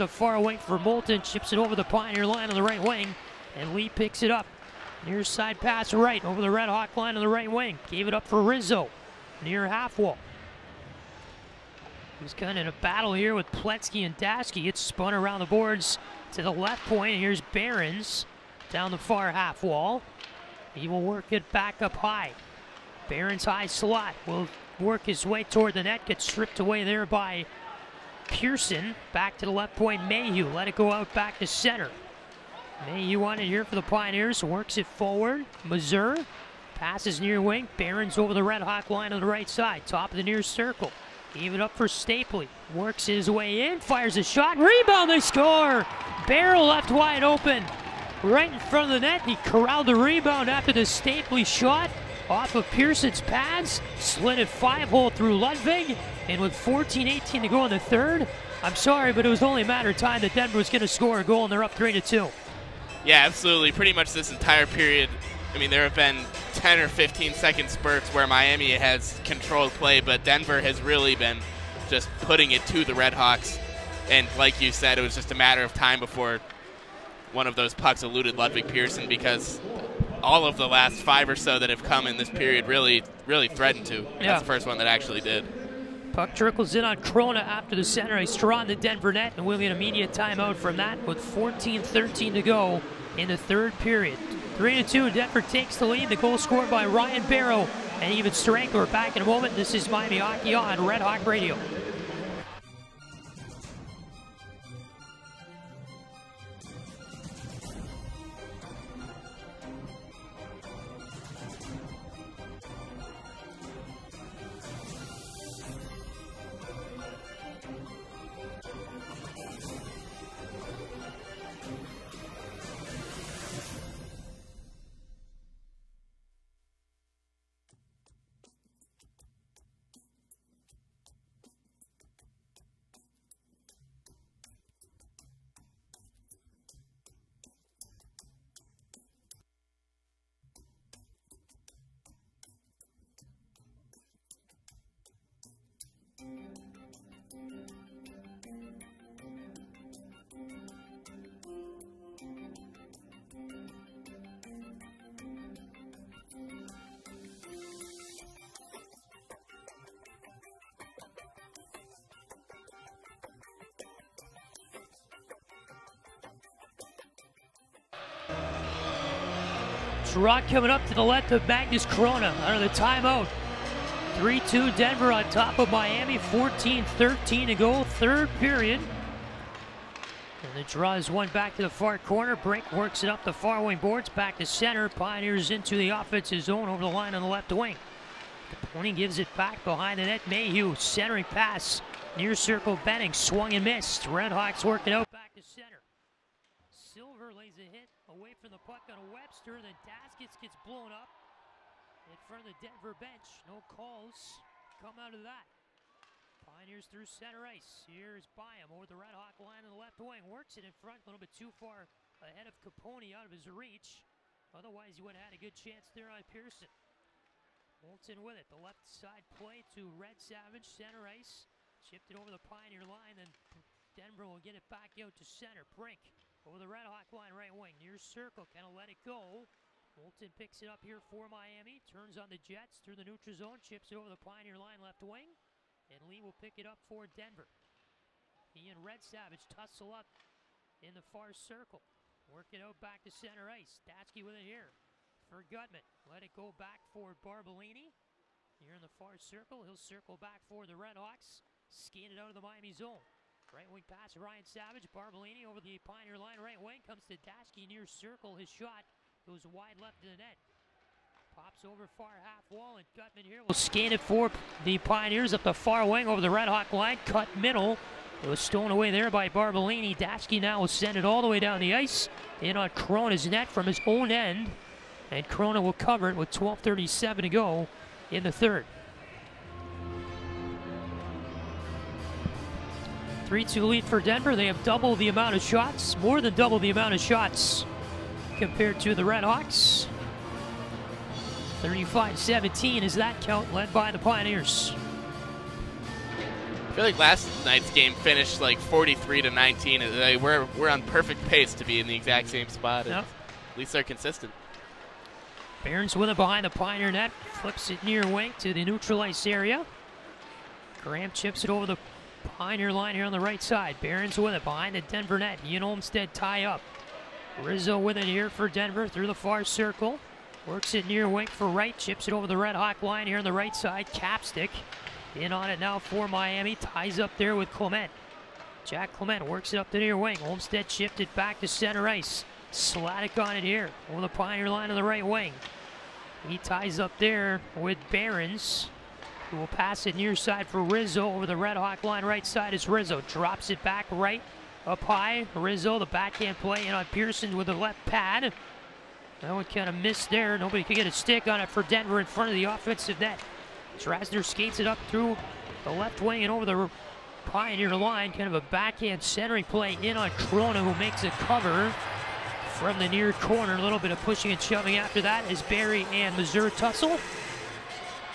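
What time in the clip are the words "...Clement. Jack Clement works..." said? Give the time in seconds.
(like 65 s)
327 s.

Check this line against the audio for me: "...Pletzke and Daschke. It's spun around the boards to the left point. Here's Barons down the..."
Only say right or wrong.
right.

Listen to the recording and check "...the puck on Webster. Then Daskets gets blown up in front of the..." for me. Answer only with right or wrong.
right.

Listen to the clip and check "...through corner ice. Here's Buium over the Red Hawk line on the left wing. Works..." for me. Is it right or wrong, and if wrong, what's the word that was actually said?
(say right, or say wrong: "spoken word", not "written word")
wrong: "center", not "corner".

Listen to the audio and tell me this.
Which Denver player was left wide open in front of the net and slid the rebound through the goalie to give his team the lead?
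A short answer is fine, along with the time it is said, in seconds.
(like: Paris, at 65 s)
Ryan Barrow, at 96 s.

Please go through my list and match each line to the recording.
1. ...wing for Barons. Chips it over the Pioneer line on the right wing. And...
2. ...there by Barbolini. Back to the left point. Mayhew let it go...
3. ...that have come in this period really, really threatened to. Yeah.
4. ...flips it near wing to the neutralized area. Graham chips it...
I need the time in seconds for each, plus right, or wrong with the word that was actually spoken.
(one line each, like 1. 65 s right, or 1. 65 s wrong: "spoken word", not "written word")
1. 0 s wrong: "Moulton", not "Barons"
2. 26 s wrong: "Persson", not "Barbolini"
3. 81 s right
4. 307 s right.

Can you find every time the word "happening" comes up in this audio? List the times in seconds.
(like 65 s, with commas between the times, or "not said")
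not said.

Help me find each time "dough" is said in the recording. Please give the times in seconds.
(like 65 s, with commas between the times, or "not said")
not said.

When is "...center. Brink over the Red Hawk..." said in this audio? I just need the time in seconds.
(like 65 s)
225 s.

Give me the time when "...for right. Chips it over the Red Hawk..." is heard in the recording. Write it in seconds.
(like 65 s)
321 s.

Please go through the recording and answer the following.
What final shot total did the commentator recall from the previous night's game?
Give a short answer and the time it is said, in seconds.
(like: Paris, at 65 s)
43 to 19, at 298 s.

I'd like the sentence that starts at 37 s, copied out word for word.
Barron's over the Red Hawk line on the right side, top of the near circle.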